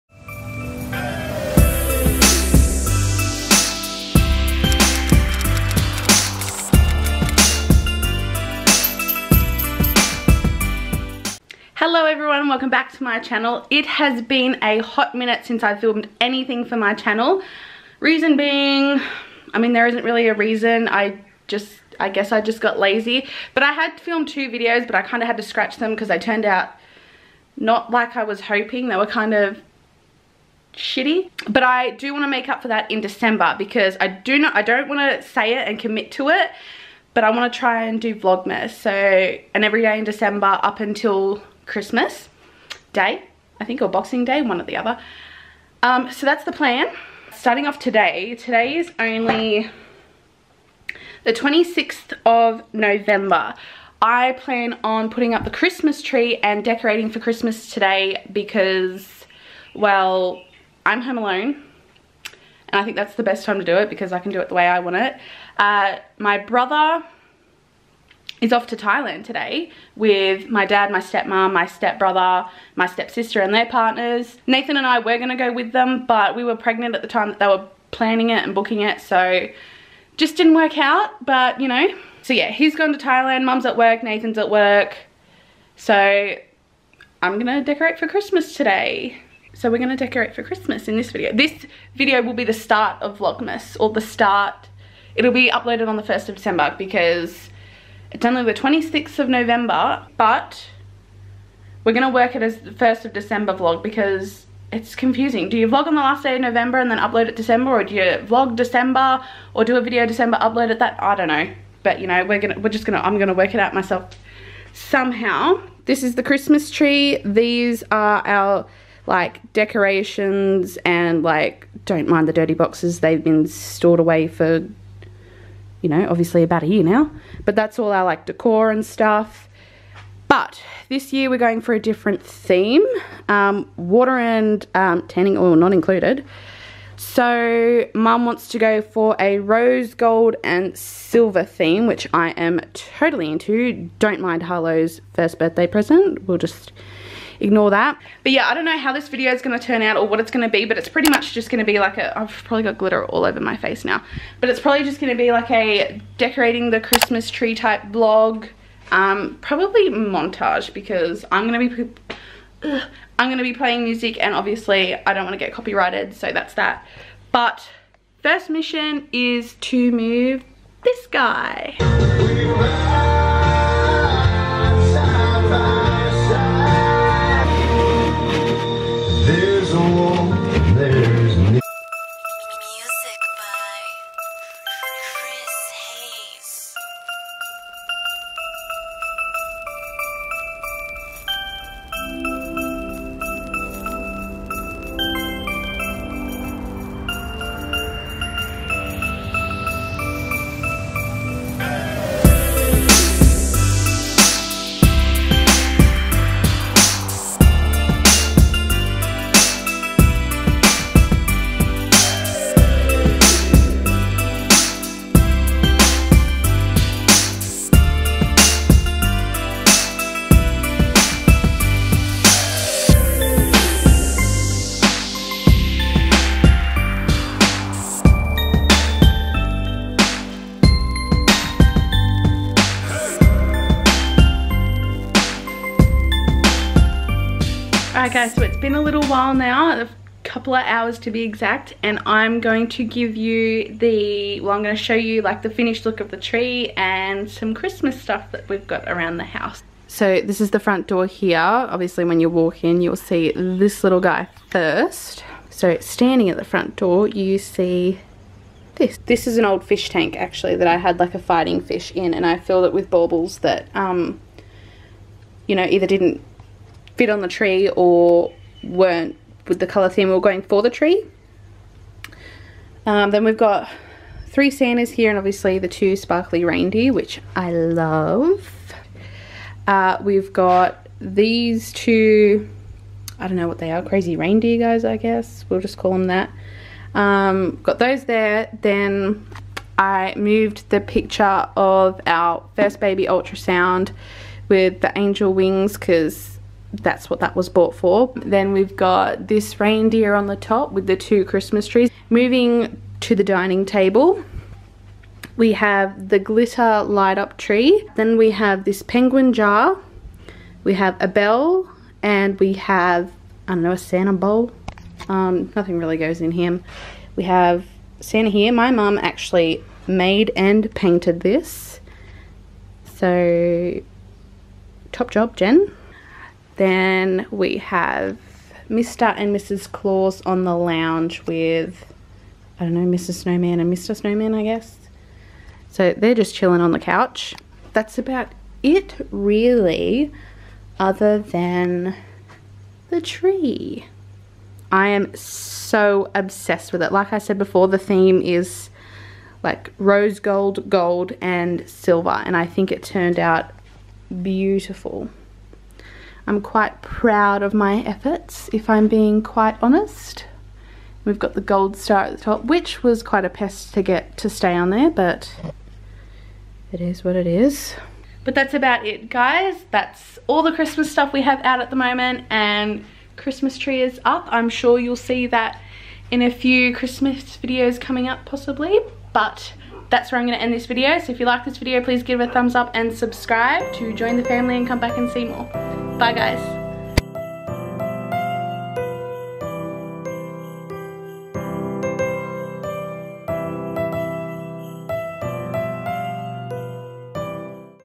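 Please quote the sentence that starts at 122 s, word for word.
They've been stored away for you know, obviously about a year now.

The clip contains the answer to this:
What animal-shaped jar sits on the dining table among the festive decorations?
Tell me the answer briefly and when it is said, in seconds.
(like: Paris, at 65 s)
Penguin, at 308 s.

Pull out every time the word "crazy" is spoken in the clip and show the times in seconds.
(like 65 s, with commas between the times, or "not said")
283 s.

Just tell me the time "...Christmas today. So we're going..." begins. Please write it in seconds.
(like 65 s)
88 s.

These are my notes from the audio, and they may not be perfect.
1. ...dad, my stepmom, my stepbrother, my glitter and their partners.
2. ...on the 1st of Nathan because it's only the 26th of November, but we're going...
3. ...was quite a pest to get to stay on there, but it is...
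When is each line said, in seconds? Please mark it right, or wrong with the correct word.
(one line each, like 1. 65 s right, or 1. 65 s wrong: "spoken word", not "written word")
1. 70 s wrong: "stepsister", not "glitter"
2. 95 s wrong: "December", not "Nathan"
3. 362 s right.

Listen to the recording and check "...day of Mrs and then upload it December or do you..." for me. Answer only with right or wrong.
wrong.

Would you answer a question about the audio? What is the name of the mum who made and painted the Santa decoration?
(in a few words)
Jen.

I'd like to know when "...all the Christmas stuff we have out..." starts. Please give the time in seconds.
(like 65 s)
370 s.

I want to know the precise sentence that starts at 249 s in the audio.
So this is the front door here.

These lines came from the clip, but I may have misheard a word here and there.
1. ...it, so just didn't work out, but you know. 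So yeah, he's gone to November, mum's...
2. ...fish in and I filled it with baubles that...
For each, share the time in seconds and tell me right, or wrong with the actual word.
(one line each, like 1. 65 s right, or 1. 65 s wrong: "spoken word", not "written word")
1. 78 s wrong: "Thailand", not "November"
2. 261 s right.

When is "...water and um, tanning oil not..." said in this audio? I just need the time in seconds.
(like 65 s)
133 s.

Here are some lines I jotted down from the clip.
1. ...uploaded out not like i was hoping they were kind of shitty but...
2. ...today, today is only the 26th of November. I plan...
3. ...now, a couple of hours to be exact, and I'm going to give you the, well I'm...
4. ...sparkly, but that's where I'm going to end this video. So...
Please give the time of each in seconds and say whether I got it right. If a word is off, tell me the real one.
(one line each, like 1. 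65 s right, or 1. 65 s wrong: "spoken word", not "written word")
1. 26 s wrong: "turned", not "uploaded"
2. 47 s right
3. 239 s right
4. 378 s wrong: "possibly", not "sparkly".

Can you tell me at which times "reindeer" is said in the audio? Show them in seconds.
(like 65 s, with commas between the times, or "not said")
276 s, 284 s, 299 s.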